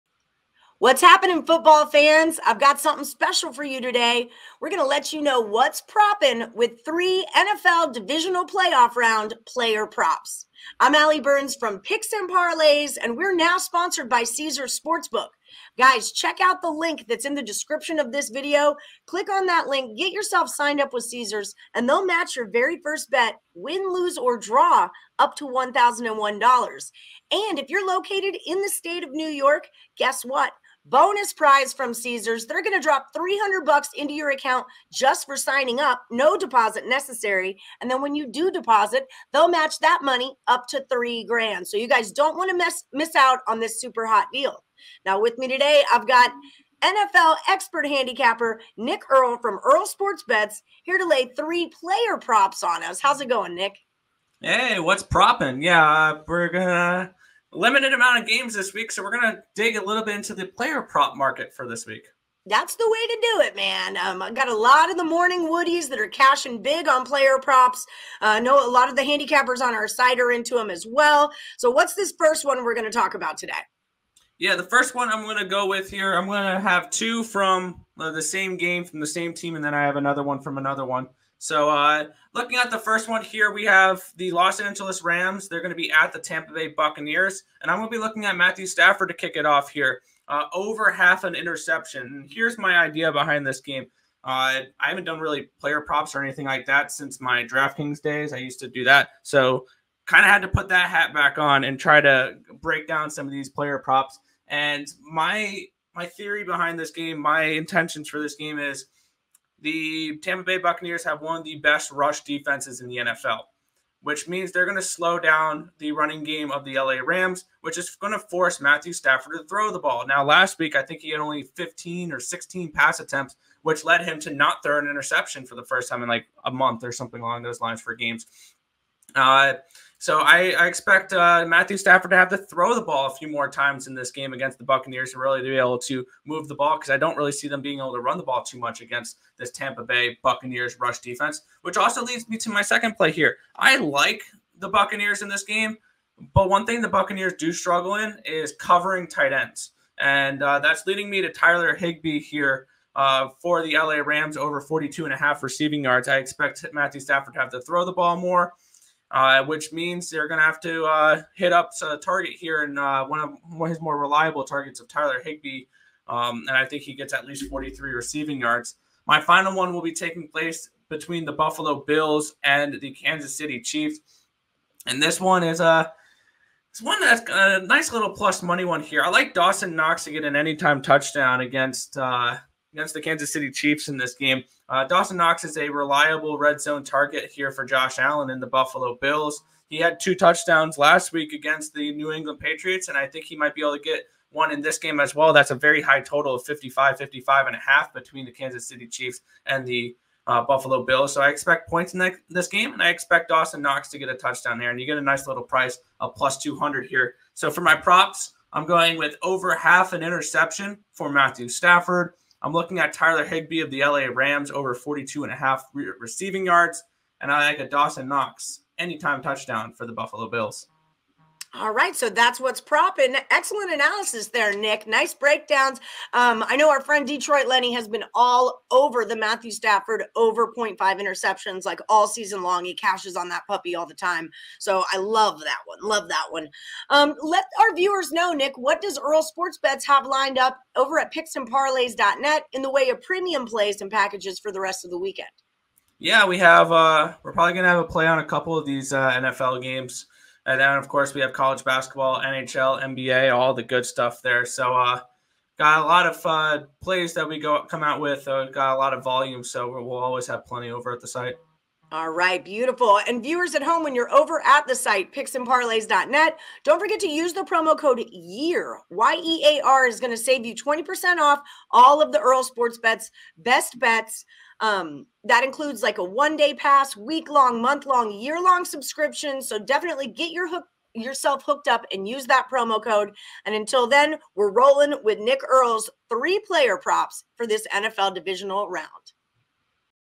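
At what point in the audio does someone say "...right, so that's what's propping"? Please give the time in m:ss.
3:41.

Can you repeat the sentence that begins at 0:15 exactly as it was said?
Guys, check out the link that's in the description of this video.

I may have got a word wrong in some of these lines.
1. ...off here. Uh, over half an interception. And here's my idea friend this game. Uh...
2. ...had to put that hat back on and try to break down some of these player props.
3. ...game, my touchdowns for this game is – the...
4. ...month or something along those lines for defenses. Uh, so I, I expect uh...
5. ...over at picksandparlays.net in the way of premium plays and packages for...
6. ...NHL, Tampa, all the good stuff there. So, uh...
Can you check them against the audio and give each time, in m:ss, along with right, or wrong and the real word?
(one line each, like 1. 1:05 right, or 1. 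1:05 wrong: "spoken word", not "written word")
1. 1:29 wrong: "behind", not "friend"
2. 1:40 right
3. 1:46 wrong: "intentions", not "touchdowns"
4. 2:06 wrong: "games", not "defenses"
5. 4:00 right
6. 4:12 wrong: "NBA", not "Tampa".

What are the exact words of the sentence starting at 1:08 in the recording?
Uh, I uh, know a lot of the handicappers on our side are into them as well.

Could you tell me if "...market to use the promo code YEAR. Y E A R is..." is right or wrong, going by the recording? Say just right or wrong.
wrong.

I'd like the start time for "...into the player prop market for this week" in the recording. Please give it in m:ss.
1:00.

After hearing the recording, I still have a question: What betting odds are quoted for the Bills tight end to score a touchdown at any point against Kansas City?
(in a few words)
+200.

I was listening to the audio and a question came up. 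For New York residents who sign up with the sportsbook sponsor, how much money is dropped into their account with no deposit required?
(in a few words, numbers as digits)
$300.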